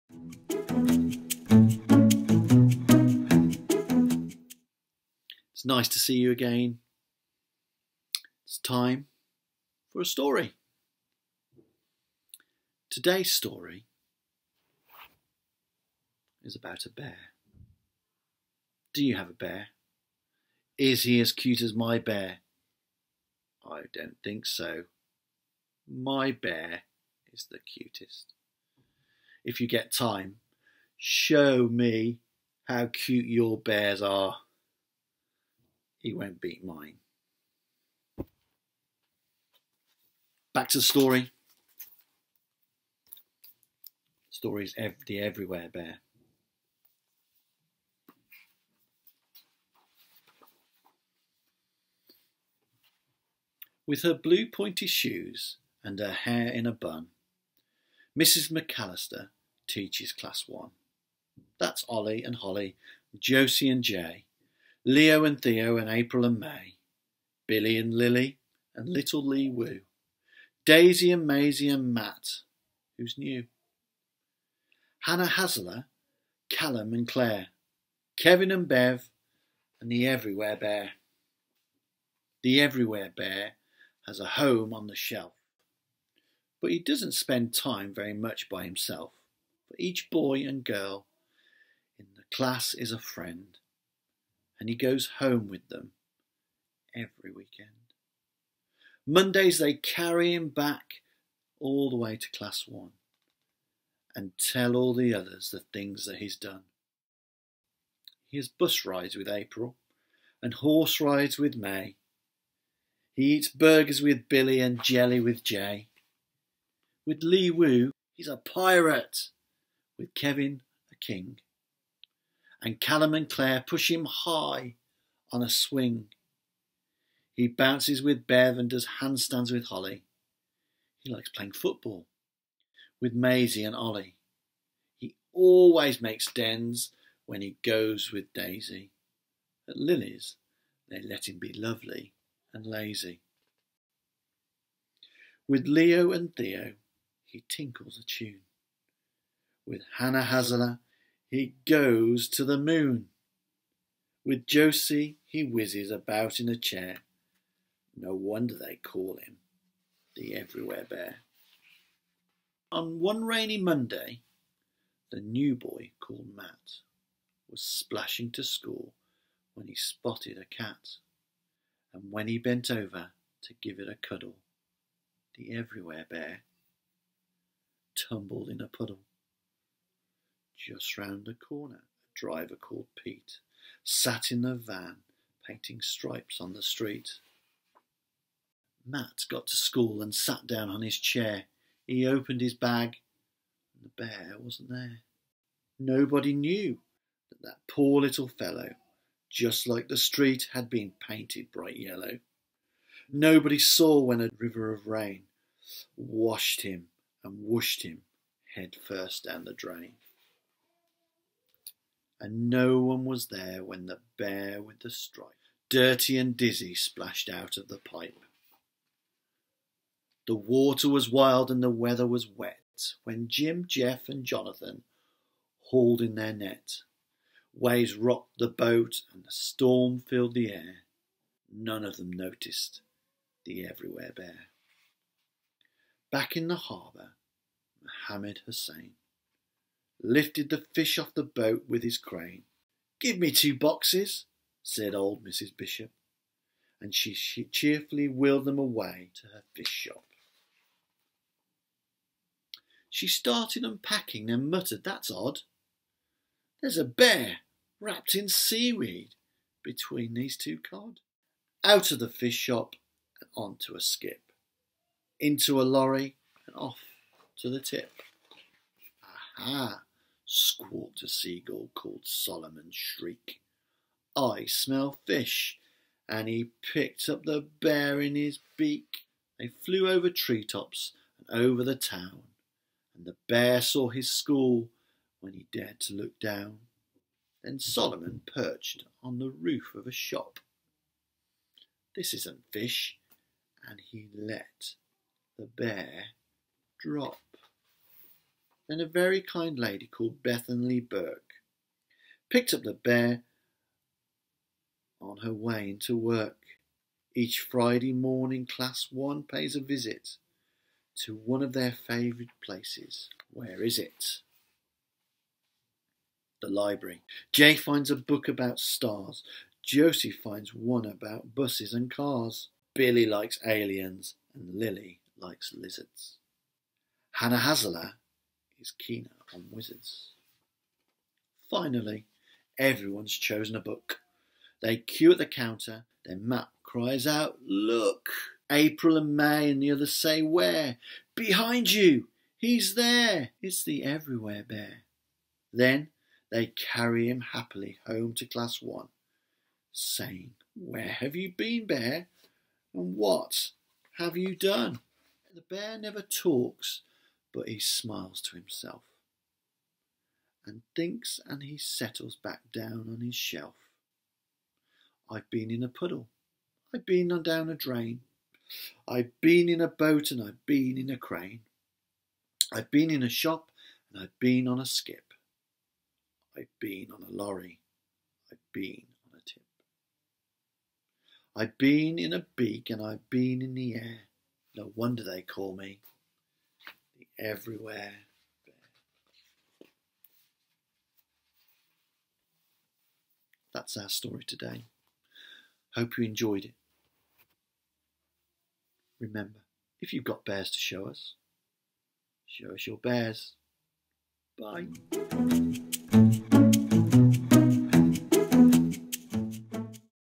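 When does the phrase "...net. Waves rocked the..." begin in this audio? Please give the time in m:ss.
3:46.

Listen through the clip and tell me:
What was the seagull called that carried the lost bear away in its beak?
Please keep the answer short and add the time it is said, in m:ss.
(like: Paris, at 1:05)
Solomon Shriek, at 4:32.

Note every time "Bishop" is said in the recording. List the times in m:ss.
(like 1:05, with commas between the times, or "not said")
4:05.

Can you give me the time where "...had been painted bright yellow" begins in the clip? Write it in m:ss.
3:20.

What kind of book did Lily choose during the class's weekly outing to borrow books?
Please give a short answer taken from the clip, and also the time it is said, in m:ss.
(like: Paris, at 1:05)
Lizards, at 5:24.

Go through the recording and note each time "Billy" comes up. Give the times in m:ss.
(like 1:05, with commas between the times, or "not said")
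1:07, 1:54, 5:22.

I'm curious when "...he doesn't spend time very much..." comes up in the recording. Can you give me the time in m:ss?
1:26.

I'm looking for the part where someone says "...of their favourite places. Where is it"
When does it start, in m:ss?
5:11.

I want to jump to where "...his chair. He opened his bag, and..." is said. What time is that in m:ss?
3:10.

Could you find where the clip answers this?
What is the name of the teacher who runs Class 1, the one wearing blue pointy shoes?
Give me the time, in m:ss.
0:58.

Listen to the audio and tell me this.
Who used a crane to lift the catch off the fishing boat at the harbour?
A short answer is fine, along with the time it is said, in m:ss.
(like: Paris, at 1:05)
Mohammed Hussein, at 3:57.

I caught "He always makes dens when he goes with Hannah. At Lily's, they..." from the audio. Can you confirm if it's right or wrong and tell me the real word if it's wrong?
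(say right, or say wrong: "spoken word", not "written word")
wrong: "Daisy", not "Hannah".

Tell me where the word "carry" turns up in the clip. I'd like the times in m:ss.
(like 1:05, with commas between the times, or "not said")
1:39, 5:46.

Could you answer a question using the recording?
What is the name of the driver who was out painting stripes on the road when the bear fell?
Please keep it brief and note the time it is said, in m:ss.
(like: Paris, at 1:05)
Pete, at 3:03.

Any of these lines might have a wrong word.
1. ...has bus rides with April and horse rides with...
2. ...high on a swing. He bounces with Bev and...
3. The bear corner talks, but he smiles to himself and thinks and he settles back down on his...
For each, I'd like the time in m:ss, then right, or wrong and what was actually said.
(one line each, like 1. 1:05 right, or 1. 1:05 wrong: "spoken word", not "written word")
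1. 1:48 right
2. 2:04 right
3. 5:55 wrong: "never", not "corner".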